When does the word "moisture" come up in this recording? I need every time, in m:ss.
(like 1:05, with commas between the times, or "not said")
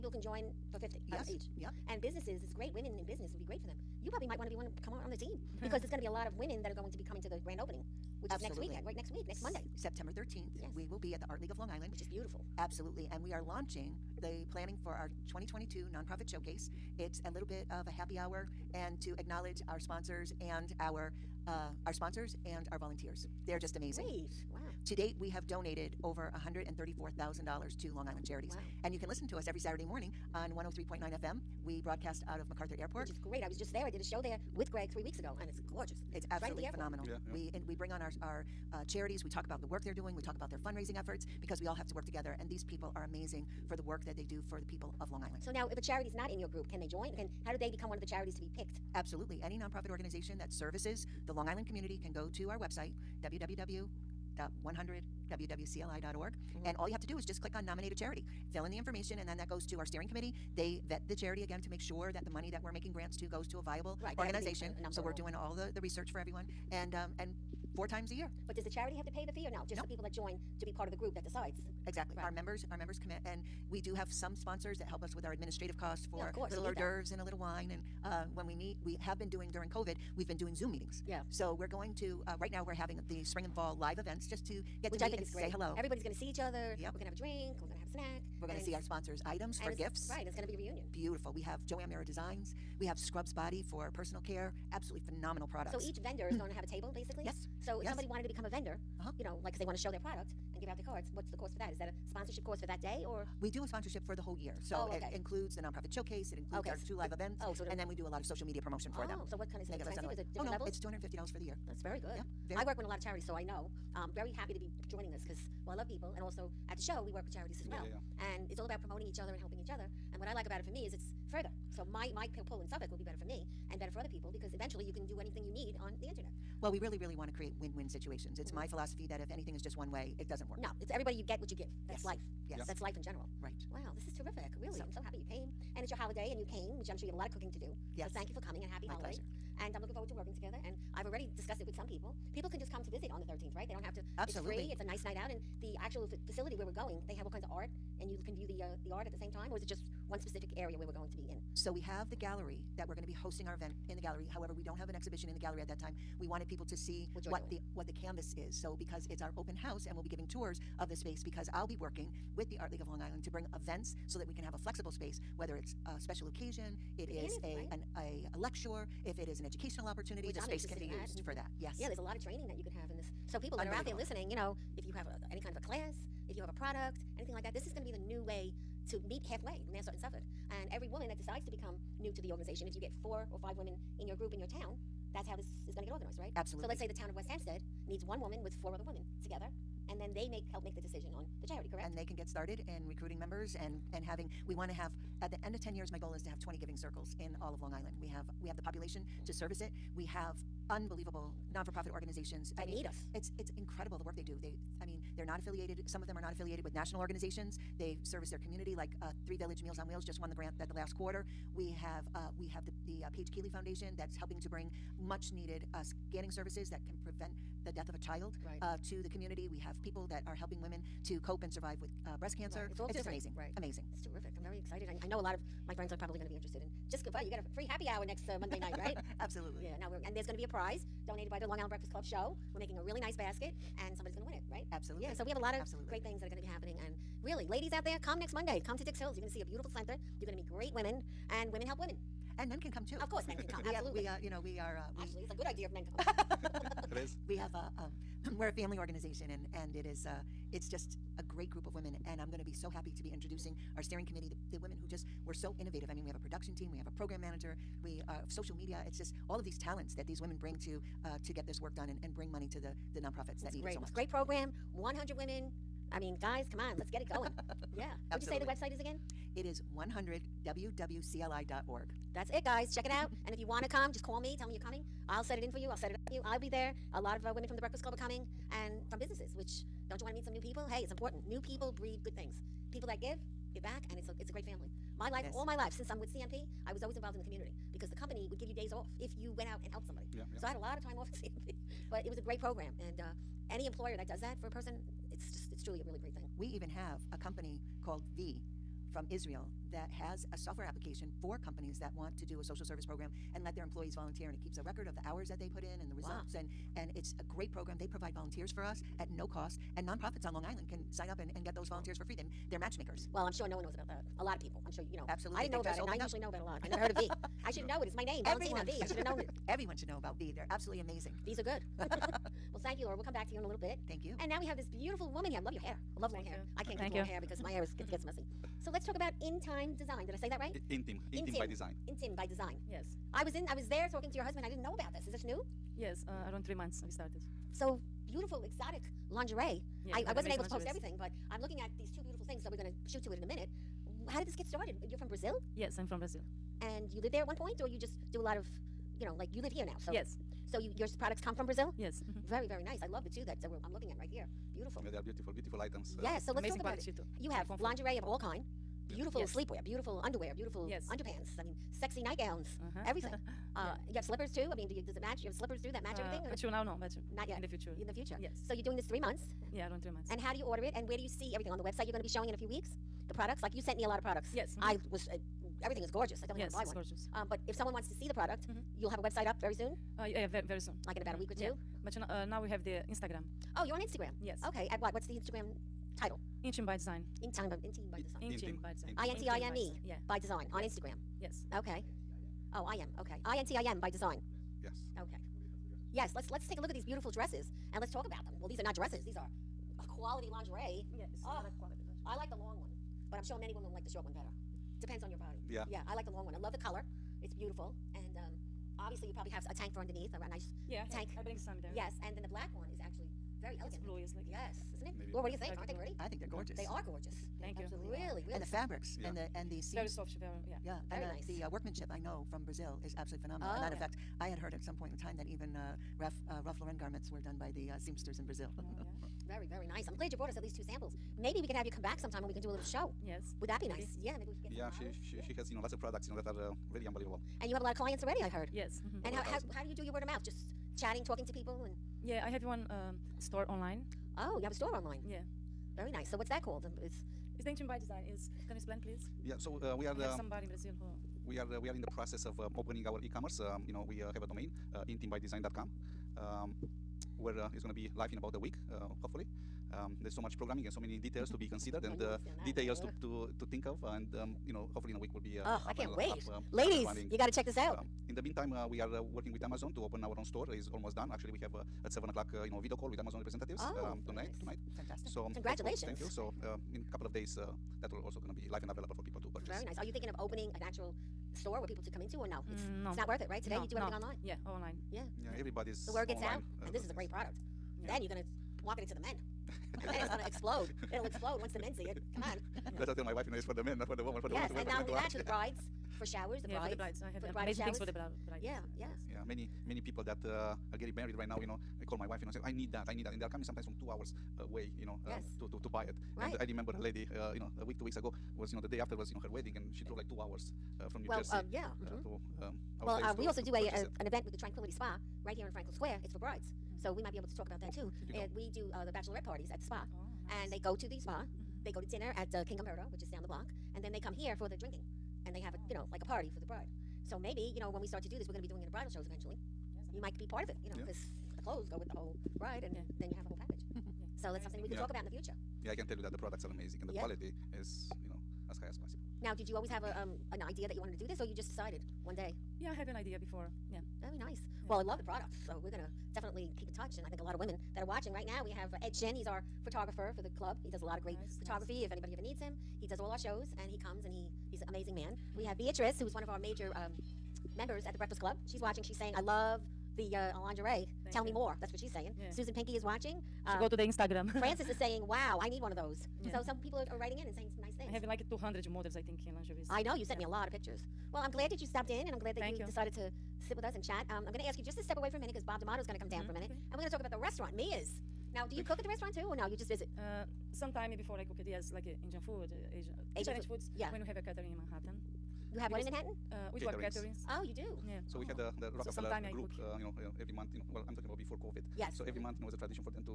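not said.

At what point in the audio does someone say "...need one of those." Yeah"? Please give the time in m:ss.
9:25.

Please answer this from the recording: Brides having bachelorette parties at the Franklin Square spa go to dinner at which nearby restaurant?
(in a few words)
King Umberto.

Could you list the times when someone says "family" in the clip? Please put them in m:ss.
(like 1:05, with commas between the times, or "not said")
4:08, 4:44.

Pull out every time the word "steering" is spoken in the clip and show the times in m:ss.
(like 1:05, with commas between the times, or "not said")
0:59, 4:13.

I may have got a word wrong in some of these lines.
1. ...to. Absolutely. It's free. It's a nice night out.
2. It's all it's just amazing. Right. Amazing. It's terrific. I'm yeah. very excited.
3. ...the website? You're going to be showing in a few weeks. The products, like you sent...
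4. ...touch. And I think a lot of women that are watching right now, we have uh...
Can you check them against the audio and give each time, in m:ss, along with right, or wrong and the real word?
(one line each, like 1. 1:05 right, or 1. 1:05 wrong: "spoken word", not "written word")
1. 2:23 right
2. 3:42 right
3. 6:11 right
4. 9:06 right.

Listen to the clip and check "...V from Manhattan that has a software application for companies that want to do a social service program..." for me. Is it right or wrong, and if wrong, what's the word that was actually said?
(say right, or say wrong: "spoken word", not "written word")
wrong: "Israel", not "Manhattan".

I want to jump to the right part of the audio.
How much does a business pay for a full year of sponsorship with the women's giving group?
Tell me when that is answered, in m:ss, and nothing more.
1:50.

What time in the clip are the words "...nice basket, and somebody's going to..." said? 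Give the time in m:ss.
3:52.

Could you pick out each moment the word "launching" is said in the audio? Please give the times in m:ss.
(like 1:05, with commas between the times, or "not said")
0:13.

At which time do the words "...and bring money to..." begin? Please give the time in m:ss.
4:22.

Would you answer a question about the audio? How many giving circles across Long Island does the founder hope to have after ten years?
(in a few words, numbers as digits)
20.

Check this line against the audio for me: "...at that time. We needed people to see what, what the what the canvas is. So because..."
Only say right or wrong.
wrong.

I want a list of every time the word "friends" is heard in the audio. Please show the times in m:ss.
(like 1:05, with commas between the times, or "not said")
3:45.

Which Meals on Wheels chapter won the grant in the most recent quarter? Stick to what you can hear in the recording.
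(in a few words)
Three Village.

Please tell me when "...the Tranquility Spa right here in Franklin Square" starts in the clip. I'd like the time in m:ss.
8:34.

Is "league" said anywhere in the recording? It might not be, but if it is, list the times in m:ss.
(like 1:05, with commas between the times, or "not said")
0:11, 2:42.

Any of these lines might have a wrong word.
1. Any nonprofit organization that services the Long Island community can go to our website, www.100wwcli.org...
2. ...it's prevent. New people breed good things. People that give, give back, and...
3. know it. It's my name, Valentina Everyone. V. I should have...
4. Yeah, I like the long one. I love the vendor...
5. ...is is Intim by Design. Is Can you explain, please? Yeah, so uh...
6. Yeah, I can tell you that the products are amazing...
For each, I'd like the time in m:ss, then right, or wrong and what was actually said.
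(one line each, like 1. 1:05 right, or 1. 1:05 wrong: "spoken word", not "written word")
1. 0:49 right
2. 4:40 wrong: "important", not "prevent"
3. 5:17 right
4. 6:45 wrong: "color", not "vendor"
5. 7:26 right
6. 8:55 right.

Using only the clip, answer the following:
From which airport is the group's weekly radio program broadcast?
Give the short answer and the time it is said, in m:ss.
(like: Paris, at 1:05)
MacArthur Airport, at 0:32.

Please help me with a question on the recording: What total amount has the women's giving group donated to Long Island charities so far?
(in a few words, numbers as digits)
$134,000.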